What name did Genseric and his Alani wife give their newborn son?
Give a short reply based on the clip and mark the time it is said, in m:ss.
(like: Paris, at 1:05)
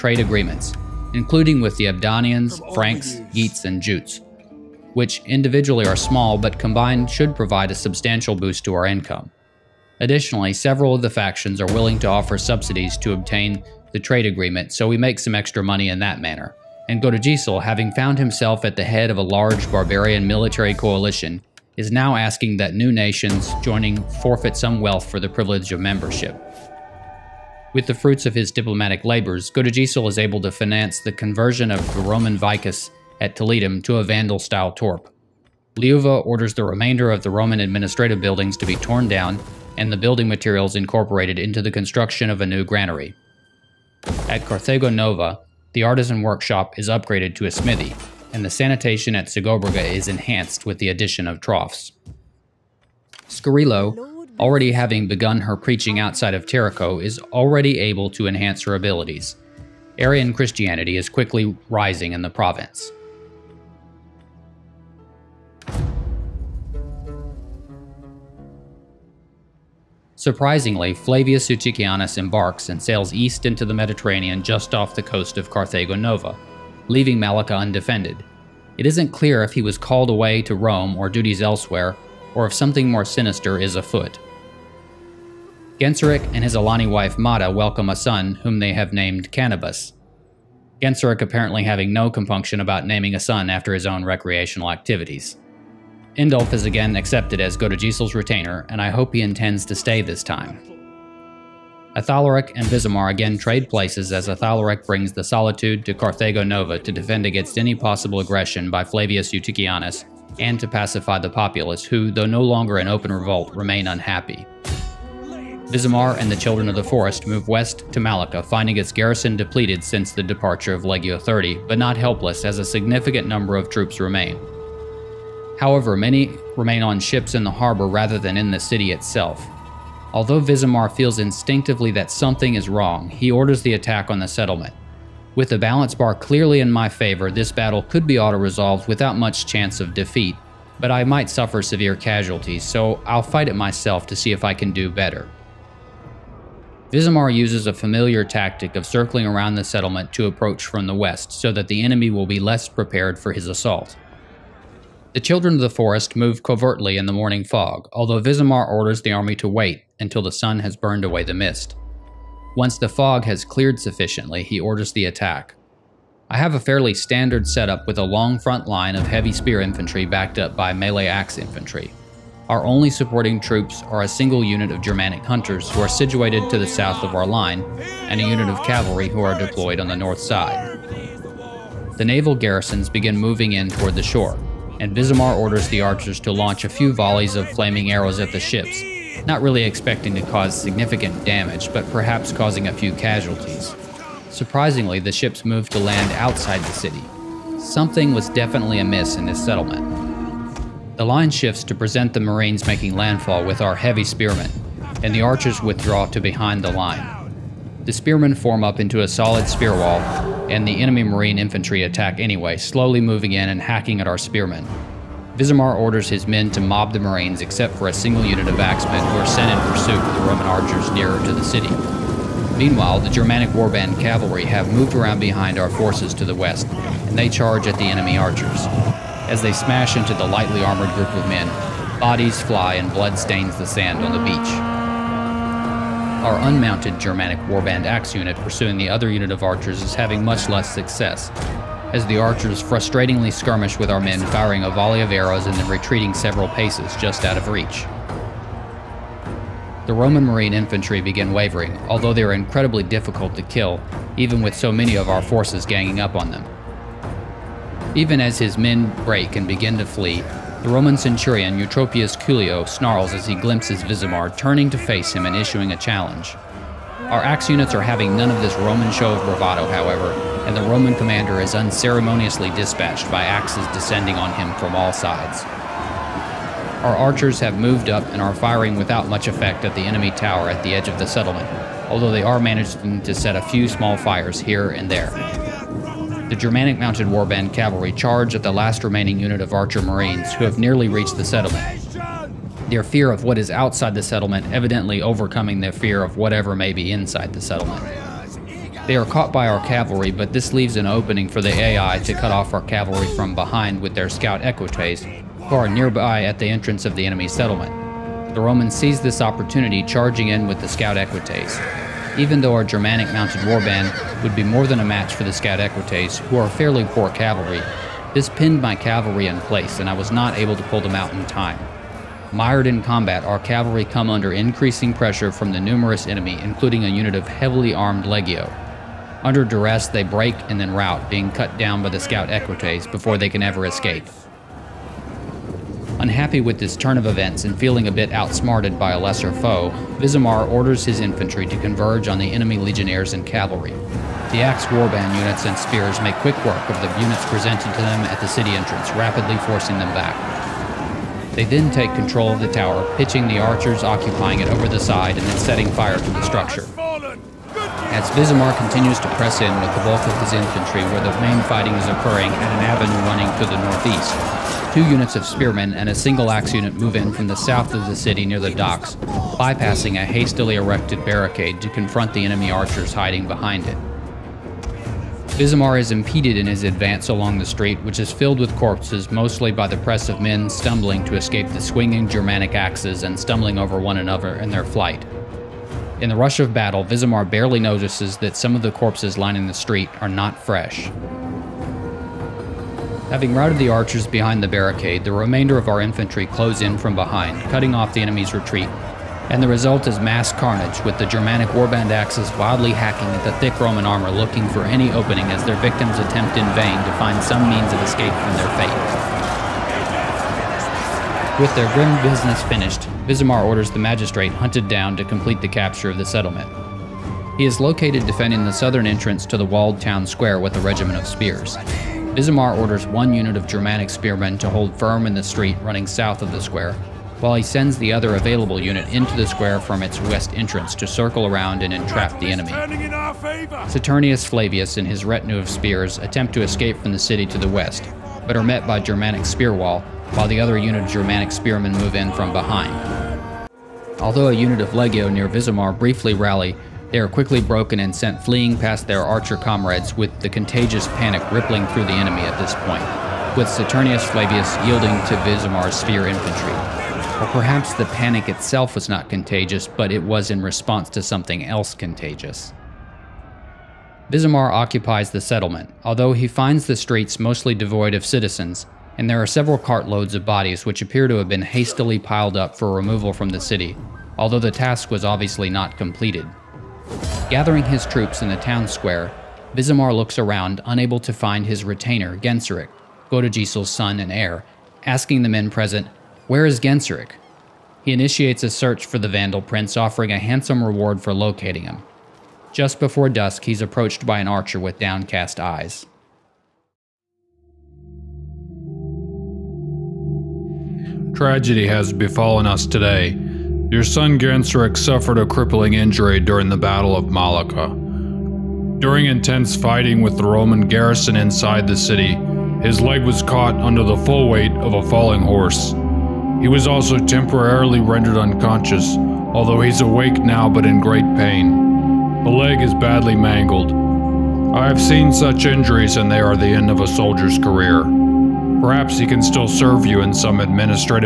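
Cannabis, at 1:29.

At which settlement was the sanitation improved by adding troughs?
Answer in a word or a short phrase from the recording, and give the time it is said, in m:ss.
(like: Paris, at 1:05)
Segobriga, at 0:49.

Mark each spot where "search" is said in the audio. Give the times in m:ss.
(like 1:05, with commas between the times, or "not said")
8:08.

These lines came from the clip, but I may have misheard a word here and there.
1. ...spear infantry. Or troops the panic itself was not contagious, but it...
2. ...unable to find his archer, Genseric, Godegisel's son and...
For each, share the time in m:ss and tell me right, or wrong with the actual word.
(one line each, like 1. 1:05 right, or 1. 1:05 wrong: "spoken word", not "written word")
1. 7:35 wrong: "perhaps", not "troops"
2. 8:00 wrong: "retainer", not "archer".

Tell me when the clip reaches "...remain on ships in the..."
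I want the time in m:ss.
2:06.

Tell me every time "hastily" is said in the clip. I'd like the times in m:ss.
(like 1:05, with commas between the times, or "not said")
6:10, 7:51.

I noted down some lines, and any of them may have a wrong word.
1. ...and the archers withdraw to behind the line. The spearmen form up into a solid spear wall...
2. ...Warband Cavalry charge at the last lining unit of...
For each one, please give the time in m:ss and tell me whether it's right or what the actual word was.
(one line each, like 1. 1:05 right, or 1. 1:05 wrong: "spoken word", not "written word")
1. 3:25 right
2. 4:47 wrong: "remaining", not "lining".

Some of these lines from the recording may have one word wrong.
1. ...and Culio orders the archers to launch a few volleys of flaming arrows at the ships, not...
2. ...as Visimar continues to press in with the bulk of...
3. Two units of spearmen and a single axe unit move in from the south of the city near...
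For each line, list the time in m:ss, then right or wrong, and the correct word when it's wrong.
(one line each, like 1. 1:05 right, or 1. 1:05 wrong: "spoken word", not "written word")
1. 3:04 wrong: "Visimar", not "Culio"
2. 5:57 right
3. 6:04 right.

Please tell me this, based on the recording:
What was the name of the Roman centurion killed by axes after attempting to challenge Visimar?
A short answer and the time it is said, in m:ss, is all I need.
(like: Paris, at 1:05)
Eutropius Culio, at 4:21.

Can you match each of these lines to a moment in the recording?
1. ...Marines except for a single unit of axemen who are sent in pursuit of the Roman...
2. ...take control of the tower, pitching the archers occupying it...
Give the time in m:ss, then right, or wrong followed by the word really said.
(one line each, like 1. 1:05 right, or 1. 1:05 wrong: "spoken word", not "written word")
1. 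3:36 right
2. 5:51 right.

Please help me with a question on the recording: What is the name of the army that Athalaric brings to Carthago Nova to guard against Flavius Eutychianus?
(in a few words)
the Solitude.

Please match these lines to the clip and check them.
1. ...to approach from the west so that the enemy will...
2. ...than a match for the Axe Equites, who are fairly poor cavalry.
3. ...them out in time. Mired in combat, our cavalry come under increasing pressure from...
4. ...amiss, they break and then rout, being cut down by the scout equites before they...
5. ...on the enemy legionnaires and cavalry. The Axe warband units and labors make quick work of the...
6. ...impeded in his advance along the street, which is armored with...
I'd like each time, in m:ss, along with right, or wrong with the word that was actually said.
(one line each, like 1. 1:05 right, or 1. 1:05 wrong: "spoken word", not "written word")
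1. 2:30 right
2. 5:14 wrong: "Scout", not "Axe"
3. 5:20 right
4. 5:29 wrong: "duress", not "amiss"
5. 5:42 wrong: "spears", not "labors"
6. 6:15 wrong: "filled", not "armored".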